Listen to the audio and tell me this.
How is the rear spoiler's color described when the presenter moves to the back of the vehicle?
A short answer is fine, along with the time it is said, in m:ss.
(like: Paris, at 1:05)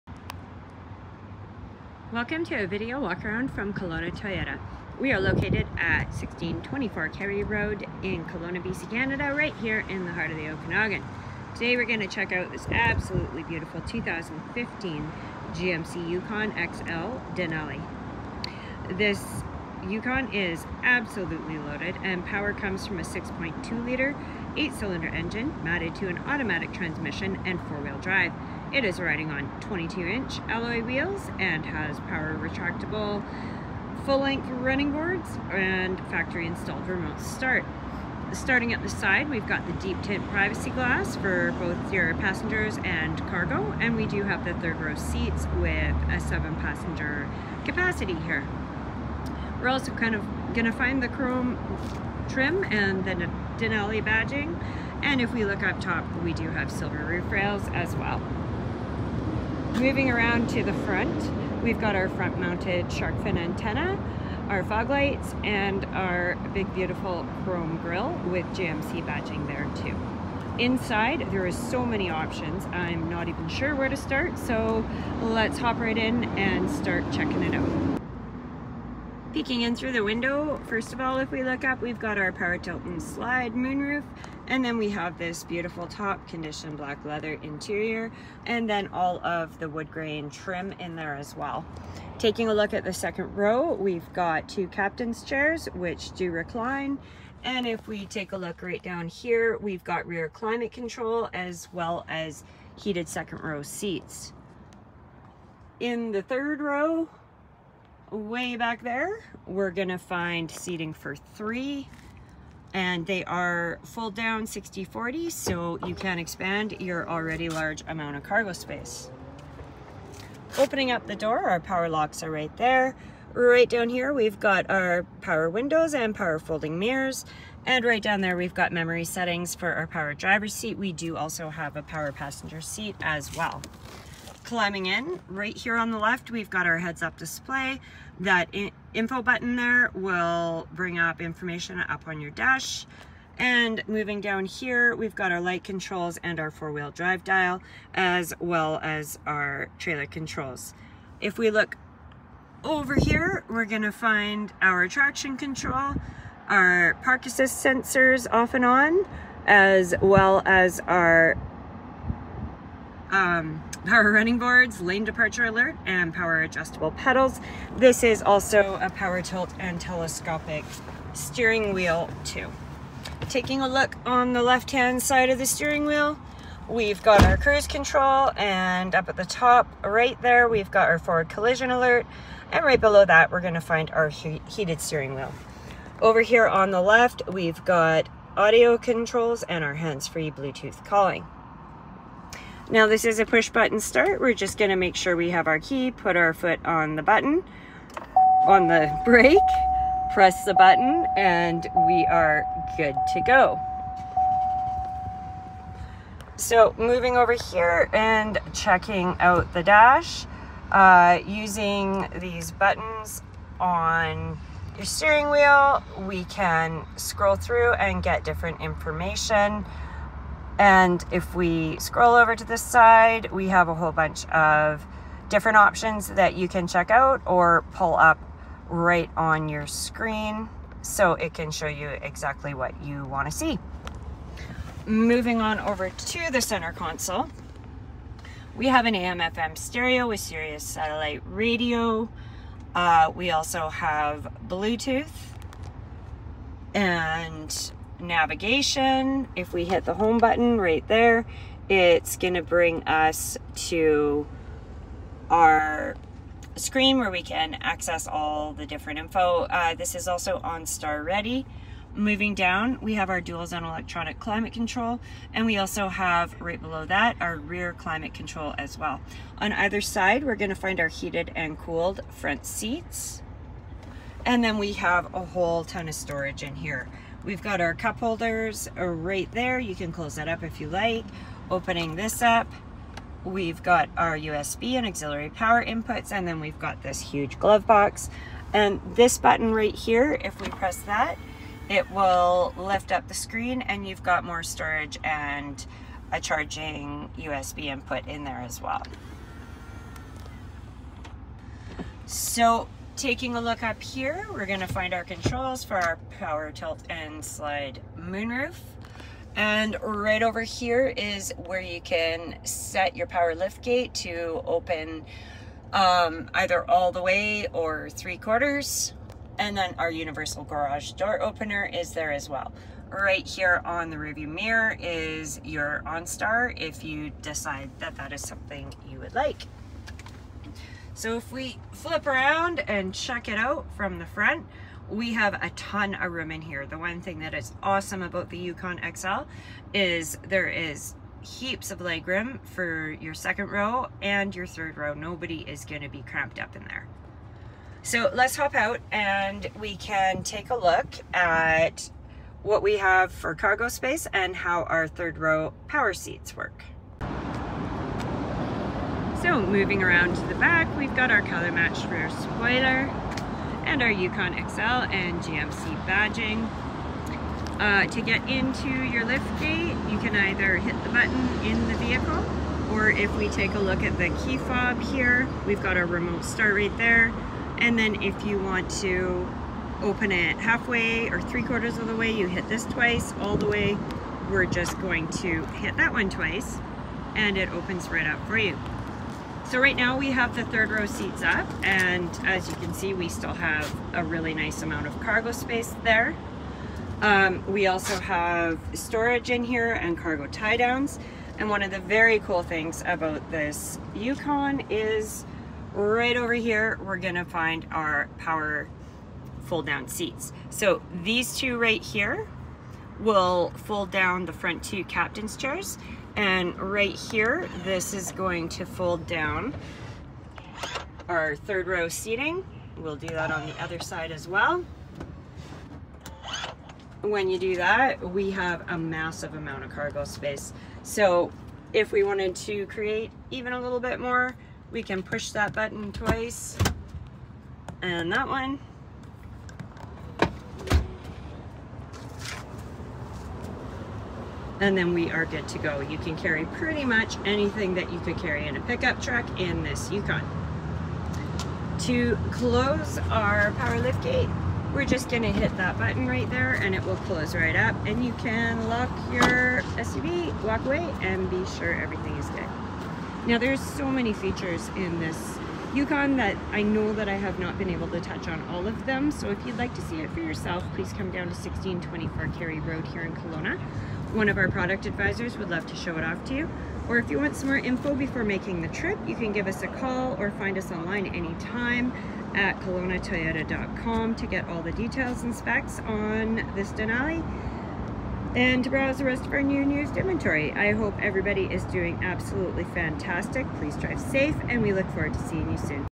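color matched, at 6:01.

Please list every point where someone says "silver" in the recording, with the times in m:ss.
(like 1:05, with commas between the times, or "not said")
0:56.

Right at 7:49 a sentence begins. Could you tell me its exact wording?
So if you'd like to see it for yourself, please come down to 1624 Cary Road here in Kelowna.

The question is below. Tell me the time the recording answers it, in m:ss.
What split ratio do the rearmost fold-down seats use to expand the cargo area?
1:54.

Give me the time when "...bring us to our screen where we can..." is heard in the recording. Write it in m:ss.
4:12.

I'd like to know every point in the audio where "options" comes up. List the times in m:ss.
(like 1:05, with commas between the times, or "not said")
1:12, 3:45.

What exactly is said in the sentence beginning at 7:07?
When you do that, we have a massive amount of cargo space.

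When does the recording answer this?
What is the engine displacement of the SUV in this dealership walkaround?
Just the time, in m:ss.
0:23.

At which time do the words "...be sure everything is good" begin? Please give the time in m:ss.
7:41.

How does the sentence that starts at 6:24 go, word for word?
We're just going to hit that one twice and it opens right up for you.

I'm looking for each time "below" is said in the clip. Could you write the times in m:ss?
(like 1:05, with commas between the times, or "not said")
3:02, 4:26.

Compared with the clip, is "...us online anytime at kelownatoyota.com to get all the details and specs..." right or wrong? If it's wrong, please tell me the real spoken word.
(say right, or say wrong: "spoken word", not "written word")
right.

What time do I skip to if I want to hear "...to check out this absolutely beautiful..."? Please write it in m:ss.
0:12.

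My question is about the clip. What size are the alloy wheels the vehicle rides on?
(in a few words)
22 inch.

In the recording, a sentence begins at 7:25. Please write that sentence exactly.
You can carry pretty much anything that you could carry in a pickup truck in this Yukon.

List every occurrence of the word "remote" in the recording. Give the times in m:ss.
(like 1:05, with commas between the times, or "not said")
0:36, 6:15.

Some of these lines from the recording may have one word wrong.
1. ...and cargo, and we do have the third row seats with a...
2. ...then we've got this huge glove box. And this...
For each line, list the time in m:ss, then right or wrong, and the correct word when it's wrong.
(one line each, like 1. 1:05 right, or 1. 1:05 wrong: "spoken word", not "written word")
1. 0:42 right
2. 4:46 right.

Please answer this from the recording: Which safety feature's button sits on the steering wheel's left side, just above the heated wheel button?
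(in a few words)
forward collision alert.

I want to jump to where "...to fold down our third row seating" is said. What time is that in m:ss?
6:58.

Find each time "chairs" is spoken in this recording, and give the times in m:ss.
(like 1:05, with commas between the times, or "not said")
1:35, 6:55.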